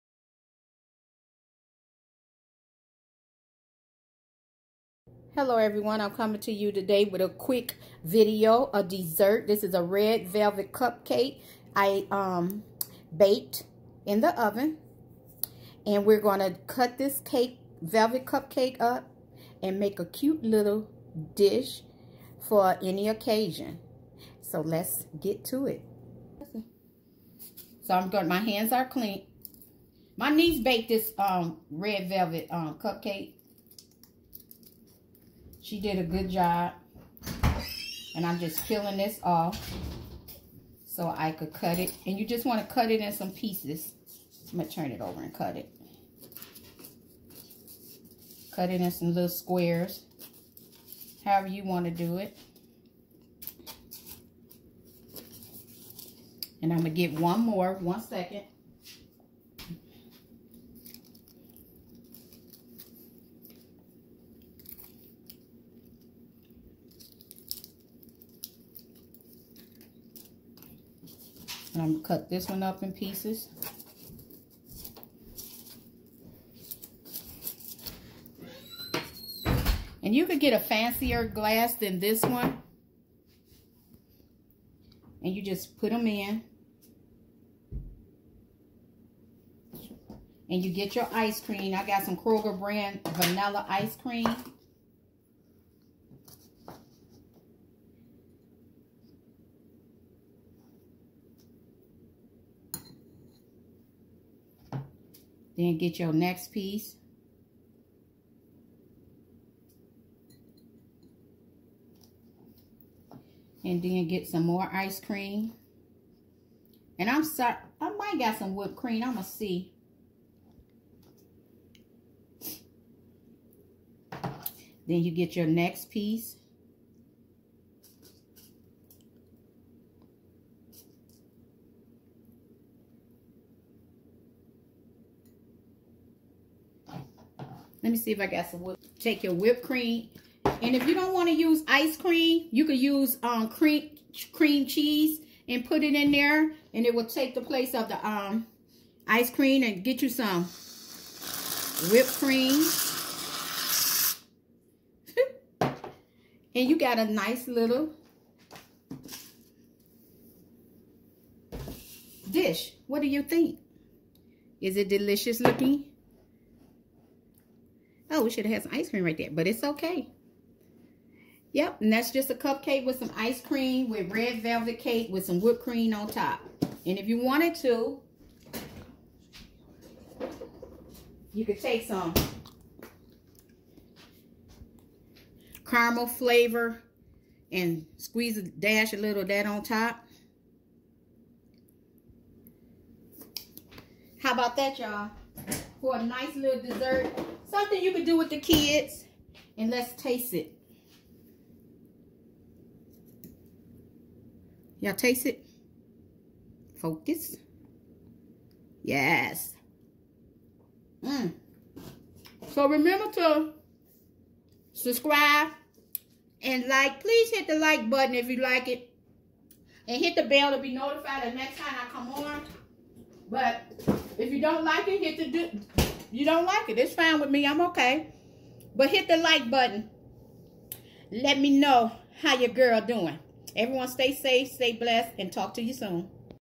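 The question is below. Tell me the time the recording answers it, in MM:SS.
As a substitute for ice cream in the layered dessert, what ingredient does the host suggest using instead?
02:24.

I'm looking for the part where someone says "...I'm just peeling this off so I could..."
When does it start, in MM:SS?
00:38.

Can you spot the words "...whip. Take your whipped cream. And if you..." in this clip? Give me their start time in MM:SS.
02:18.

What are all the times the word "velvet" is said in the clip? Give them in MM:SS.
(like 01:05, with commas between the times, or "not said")
00:10, 00:17, 00:32, 02:54.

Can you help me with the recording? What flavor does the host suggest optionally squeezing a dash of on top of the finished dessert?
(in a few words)
Caramel.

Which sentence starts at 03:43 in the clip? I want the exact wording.
But if you don't like it, hit the do you don't like it.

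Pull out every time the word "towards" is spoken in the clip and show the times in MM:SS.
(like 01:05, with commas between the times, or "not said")
not said.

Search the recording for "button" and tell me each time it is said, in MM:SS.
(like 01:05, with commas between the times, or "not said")
03:37, 03:49.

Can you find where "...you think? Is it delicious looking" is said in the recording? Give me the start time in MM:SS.
02:43.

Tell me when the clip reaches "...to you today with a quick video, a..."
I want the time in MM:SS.
00:06.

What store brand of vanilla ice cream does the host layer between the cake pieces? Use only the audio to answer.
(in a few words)
Kroger.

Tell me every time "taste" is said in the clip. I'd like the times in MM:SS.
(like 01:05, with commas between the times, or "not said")
03:20, 03:24.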